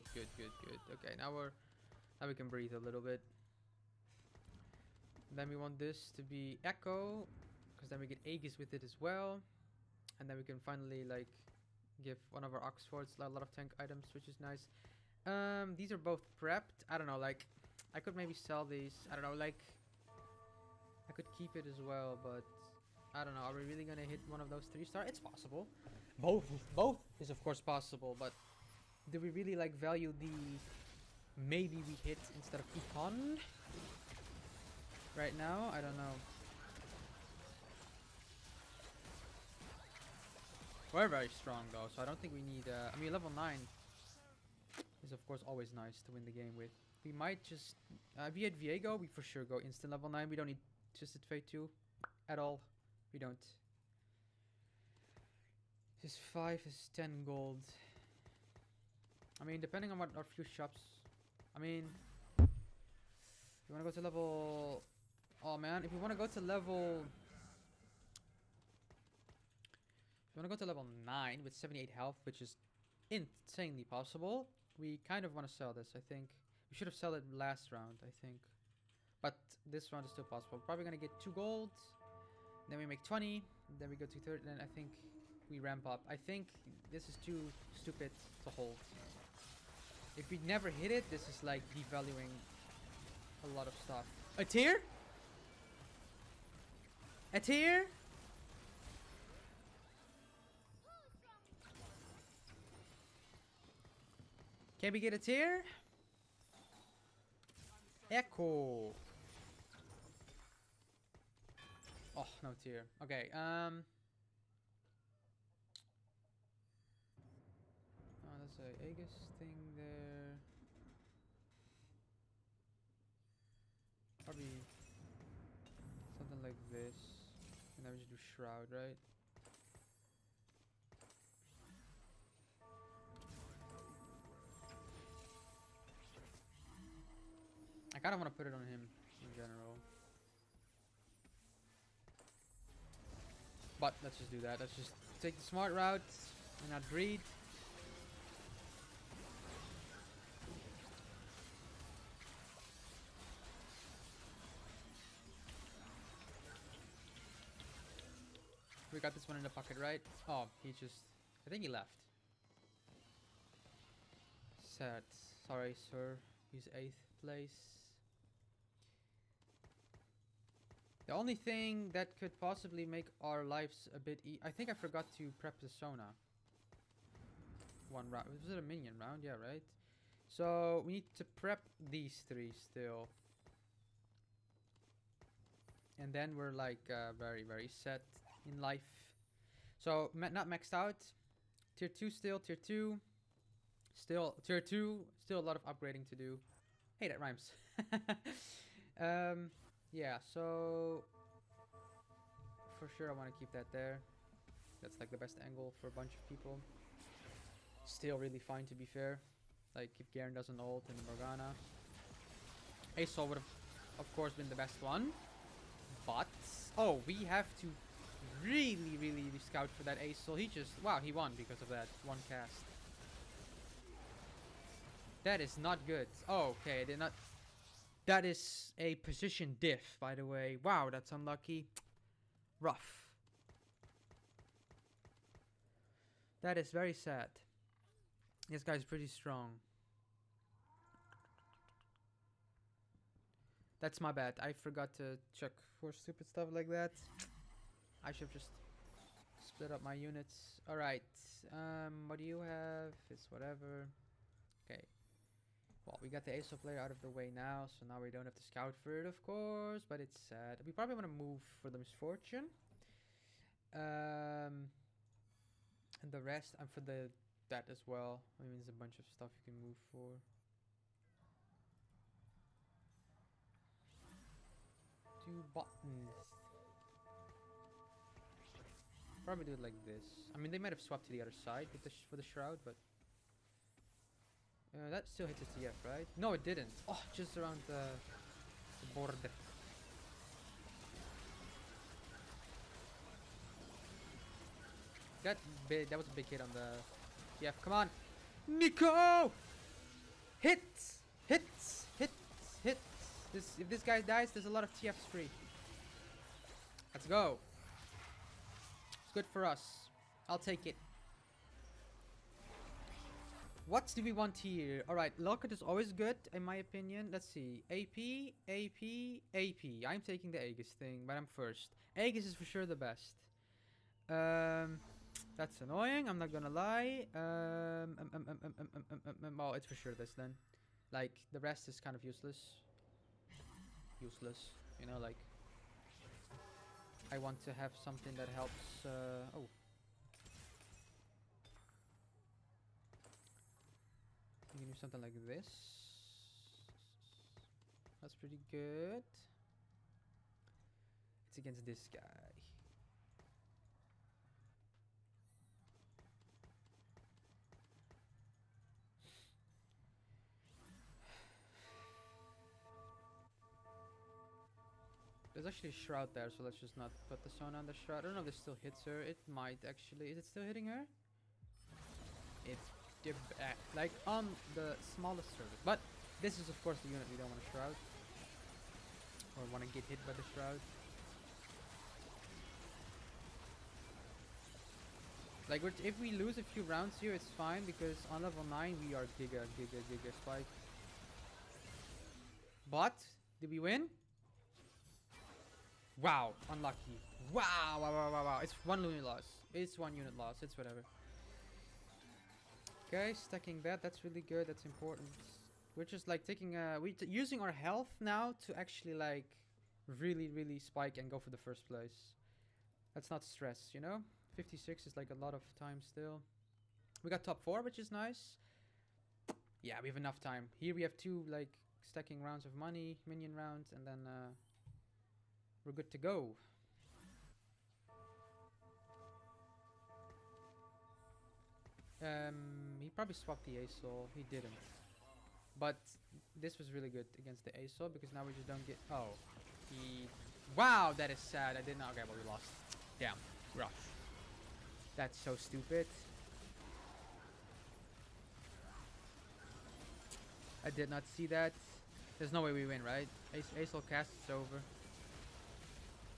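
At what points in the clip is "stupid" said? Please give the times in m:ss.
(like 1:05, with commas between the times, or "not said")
1:27, 4:05, 7:25.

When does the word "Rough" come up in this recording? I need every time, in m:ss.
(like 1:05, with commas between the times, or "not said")
3:52, 7:23.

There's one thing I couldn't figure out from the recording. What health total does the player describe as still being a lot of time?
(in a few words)
56.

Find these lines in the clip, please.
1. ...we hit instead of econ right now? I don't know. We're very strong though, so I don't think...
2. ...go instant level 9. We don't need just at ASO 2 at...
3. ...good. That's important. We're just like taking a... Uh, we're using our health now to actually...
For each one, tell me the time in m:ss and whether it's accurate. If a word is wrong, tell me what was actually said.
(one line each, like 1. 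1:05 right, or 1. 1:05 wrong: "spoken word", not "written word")
1. 0:31 right
2. 0:49 wrong: "Fate", not "ASO"
3. 6:44 right.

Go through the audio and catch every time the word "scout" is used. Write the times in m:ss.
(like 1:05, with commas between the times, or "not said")
3:39, 4:18.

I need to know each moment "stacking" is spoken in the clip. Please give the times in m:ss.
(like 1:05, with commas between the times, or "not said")
6:43, 7:01.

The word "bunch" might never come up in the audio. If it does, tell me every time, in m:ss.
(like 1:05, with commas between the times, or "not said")
3:25, 4:28.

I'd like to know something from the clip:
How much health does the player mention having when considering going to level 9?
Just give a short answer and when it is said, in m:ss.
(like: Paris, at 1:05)
78, at 1:11.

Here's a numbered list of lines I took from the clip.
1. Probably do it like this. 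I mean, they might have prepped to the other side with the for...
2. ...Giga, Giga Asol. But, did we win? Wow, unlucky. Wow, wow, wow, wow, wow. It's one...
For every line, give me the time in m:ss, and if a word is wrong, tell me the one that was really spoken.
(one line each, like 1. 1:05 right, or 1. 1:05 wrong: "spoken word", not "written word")
1. 4:39 wrong: "swapped", not "prepped"
2. 6:29 wrong: "Spike", not "Asol".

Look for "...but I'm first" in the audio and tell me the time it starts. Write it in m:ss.
5:21.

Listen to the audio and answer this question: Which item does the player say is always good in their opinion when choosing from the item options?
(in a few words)
Locket.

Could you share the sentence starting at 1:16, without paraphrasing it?
We should have sold it last round, I think.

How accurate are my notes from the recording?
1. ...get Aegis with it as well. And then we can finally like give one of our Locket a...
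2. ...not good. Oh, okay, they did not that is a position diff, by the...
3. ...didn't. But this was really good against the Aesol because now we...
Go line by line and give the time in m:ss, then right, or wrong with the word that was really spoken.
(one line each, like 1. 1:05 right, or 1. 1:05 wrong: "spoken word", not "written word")
1. 0:08 wrong: "Oxforces", not "Locket"
2. 3:45 right
3. 7:14 right.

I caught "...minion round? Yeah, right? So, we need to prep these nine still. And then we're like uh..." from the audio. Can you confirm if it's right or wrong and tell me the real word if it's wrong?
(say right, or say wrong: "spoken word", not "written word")
wrong: "three", not "nine".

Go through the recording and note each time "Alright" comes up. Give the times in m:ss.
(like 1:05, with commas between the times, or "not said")
4:10, 5:14.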